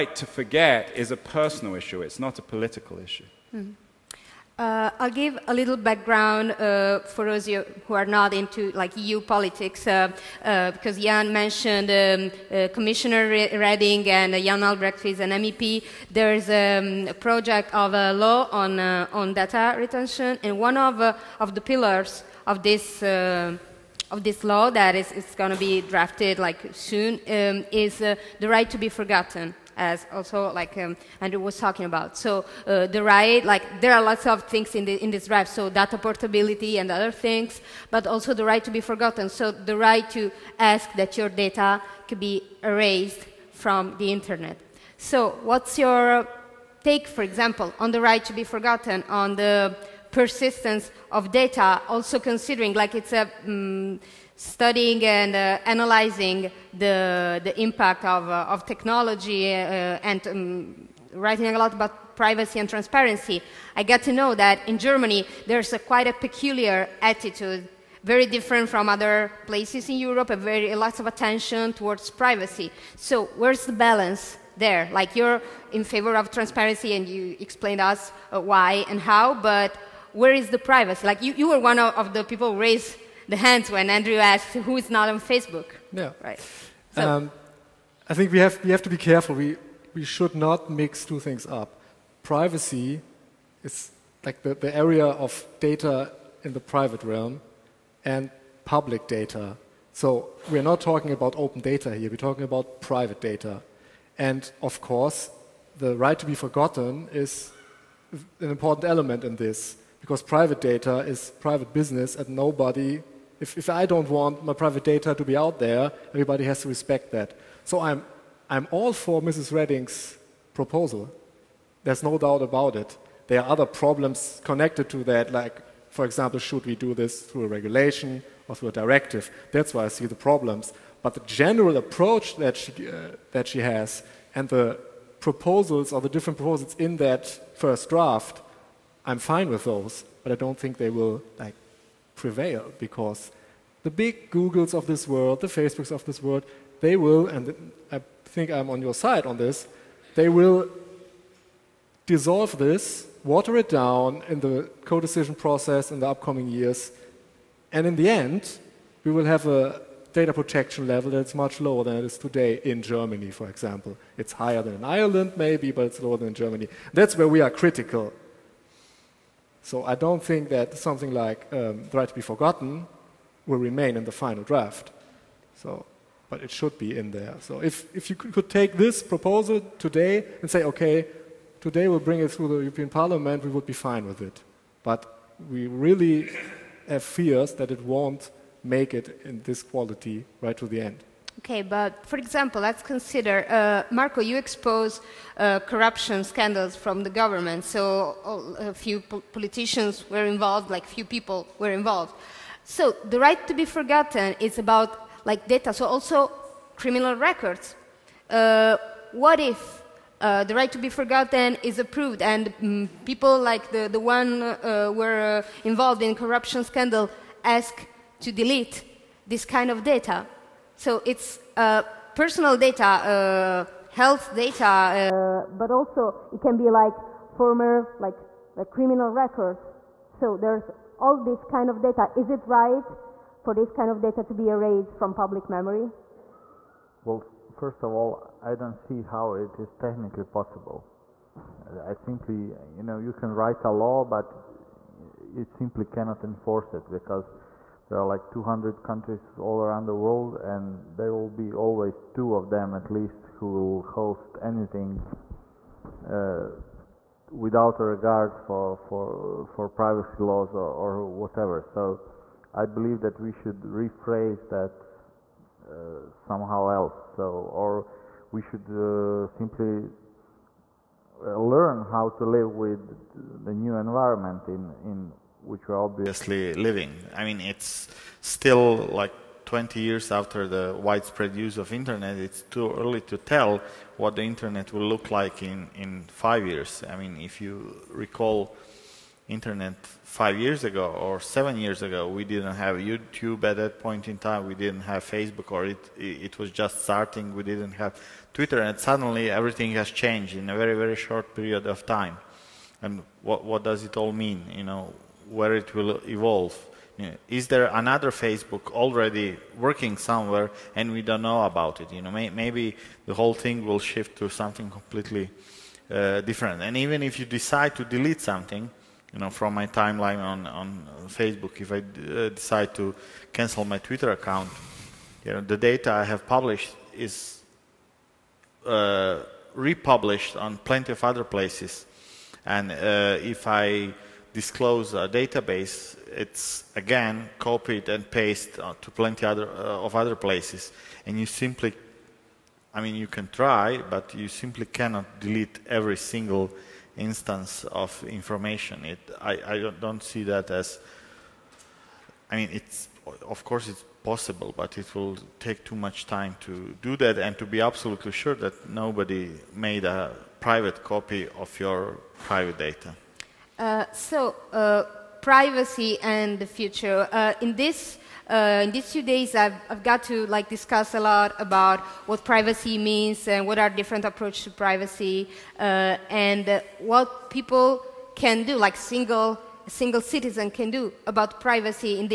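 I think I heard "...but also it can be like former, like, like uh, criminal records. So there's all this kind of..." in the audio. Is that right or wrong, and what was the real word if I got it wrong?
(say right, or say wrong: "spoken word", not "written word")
right.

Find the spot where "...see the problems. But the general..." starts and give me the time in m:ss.
2:09.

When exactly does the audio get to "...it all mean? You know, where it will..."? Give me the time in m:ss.
5:03.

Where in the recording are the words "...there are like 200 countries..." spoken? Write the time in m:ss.
4:07.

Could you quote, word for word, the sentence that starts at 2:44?
It's higher than in Ireland, maybe, but it's lower than in Germany.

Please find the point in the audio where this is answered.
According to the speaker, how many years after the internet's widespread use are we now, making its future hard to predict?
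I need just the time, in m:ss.
4:39.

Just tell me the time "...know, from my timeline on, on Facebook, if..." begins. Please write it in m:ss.
5:19.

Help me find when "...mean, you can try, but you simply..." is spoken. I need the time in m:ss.
5:42.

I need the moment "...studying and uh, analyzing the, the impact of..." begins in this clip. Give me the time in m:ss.
0:54.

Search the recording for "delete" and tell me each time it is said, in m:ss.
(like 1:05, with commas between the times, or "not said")
3:38, 5:17, 5:45.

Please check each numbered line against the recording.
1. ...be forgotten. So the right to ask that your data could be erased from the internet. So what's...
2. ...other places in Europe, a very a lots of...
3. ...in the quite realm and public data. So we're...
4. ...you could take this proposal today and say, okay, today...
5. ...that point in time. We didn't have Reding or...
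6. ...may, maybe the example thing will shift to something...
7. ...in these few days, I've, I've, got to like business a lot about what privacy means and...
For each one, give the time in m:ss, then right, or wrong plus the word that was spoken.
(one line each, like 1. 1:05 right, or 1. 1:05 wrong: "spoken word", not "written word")
1. 0:38 right
2. 1:08 right
3. 1:36 wrong: "private", not "quite"
4. 2:58 right
5. 4:53 wrong: "Facebook", not "Reding"
6. 5:12 wrong: "whole", not "example"
7. 6:08 wrong: "discuss", not "business".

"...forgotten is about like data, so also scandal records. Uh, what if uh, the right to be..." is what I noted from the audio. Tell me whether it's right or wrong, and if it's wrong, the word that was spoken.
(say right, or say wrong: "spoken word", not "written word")
wrong: "criminal", not "scandal".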